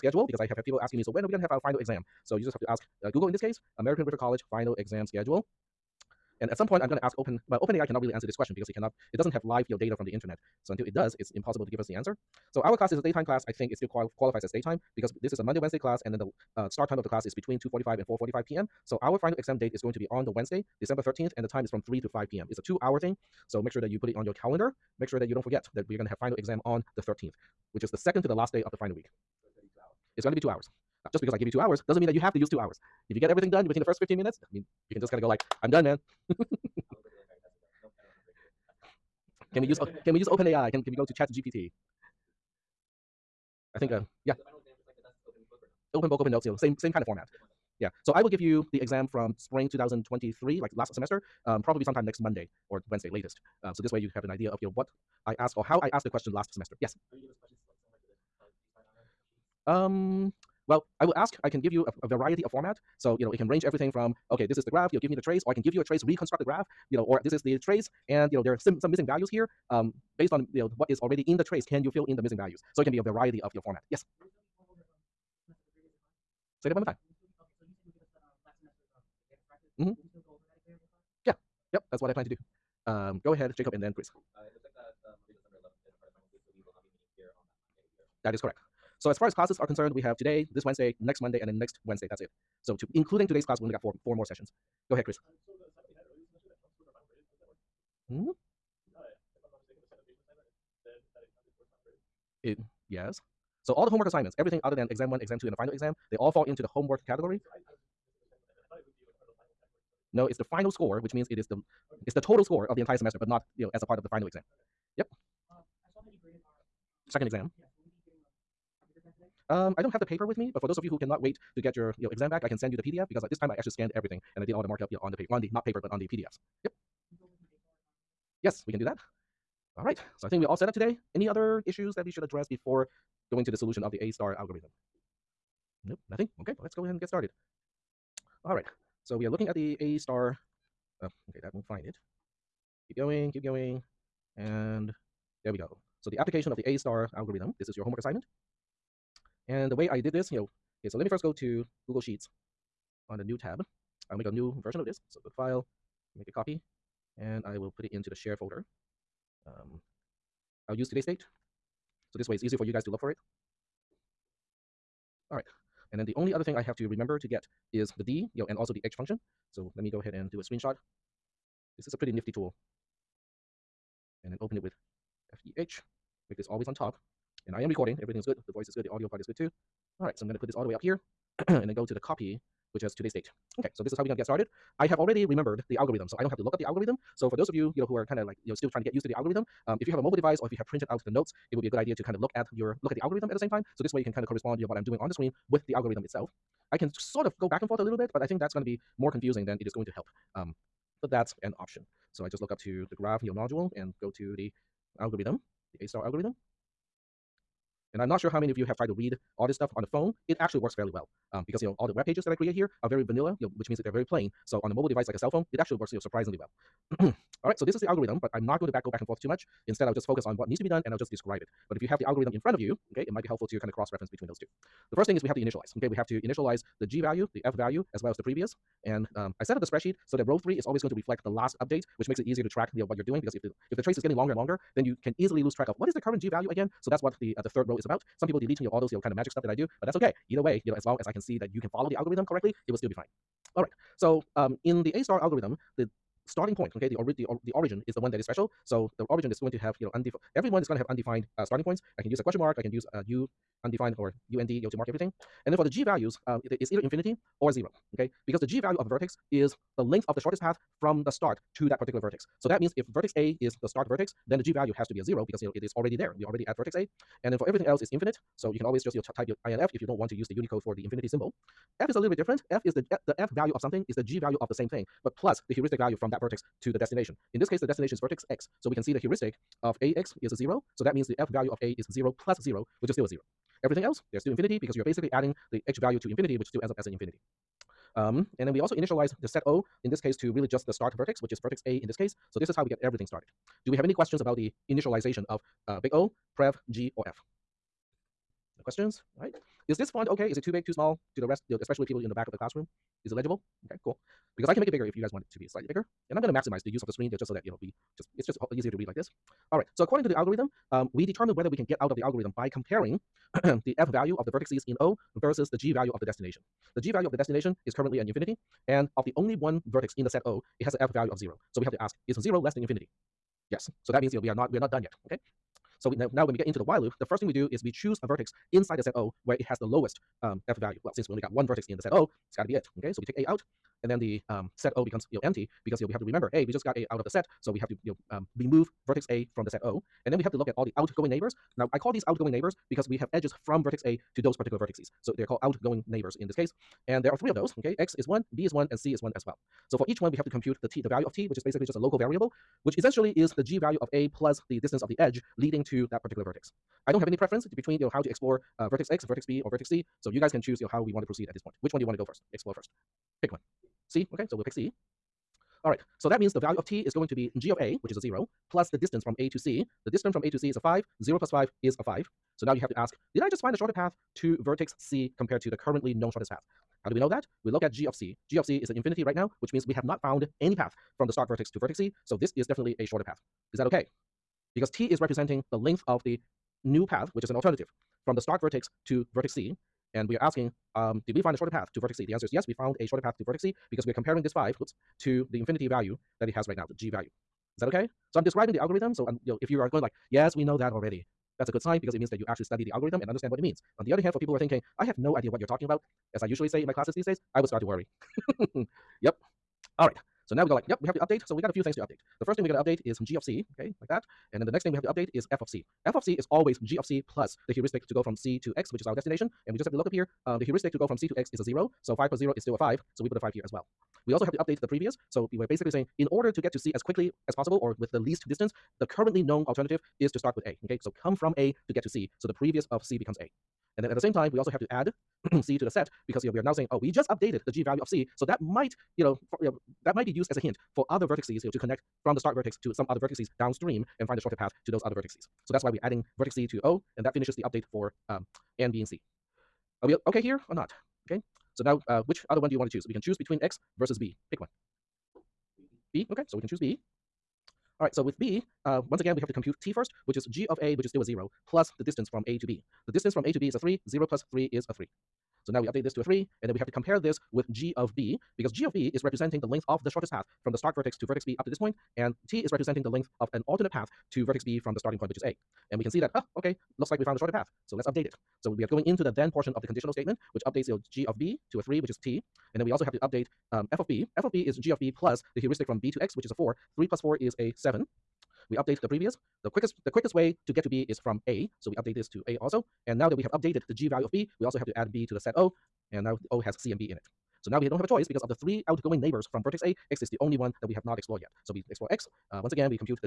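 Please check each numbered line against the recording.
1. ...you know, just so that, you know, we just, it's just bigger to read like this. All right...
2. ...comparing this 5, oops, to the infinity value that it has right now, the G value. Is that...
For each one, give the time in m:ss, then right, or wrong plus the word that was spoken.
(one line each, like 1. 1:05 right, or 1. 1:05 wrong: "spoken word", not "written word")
1. 5:07 wrong: "easier", not "bigger"
2. 6:33 right.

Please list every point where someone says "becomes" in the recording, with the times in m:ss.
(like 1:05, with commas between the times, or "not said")
5:34, 7:12.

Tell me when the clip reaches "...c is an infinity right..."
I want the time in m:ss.
6:18.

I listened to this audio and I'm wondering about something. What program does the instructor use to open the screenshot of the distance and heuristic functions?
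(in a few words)
FEH.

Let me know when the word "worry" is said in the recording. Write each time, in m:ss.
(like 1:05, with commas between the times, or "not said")
6:47.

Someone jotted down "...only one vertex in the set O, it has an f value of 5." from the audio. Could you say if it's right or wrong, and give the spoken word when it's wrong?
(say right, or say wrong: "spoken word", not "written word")
wrong: "0", not "5".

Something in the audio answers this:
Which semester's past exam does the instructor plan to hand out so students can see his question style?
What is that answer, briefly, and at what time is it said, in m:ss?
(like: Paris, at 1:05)
spring 2023, at 0:49.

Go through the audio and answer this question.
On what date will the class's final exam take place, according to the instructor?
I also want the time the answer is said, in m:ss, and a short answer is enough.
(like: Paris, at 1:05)
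December 13th, at 0:20.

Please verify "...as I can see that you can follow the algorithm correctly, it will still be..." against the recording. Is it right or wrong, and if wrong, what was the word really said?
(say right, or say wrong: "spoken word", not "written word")
right.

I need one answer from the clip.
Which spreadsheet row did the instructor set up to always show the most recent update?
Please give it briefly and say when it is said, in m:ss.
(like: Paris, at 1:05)
row 3, at 3:50.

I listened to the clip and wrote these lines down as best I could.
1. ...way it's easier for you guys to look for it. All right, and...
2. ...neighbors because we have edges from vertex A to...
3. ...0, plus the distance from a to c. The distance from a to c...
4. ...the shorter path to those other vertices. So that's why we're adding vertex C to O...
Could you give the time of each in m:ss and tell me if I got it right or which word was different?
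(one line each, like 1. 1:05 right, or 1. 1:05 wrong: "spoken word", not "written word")
1. 2:42 right
2. 5:42 right
3. 6:07 right
4. 7:24 right.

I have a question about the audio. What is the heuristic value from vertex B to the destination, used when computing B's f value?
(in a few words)
4.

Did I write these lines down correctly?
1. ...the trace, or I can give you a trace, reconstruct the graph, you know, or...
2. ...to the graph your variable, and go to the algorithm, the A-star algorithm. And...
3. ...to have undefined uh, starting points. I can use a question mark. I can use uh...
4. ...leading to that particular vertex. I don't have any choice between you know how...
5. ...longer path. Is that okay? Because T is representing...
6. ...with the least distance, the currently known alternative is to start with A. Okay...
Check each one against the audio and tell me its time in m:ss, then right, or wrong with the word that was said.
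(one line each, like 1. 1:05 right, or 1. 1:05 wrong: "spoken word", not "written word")
1. 1:05 right
2. 3:22 wrong: "module", not "variable"
3. 4:10 right
4. 5:55 wrong: "preference", not "choice"
5. 6:22 wrong: "shorter", not "longer"
6. 7:07 right.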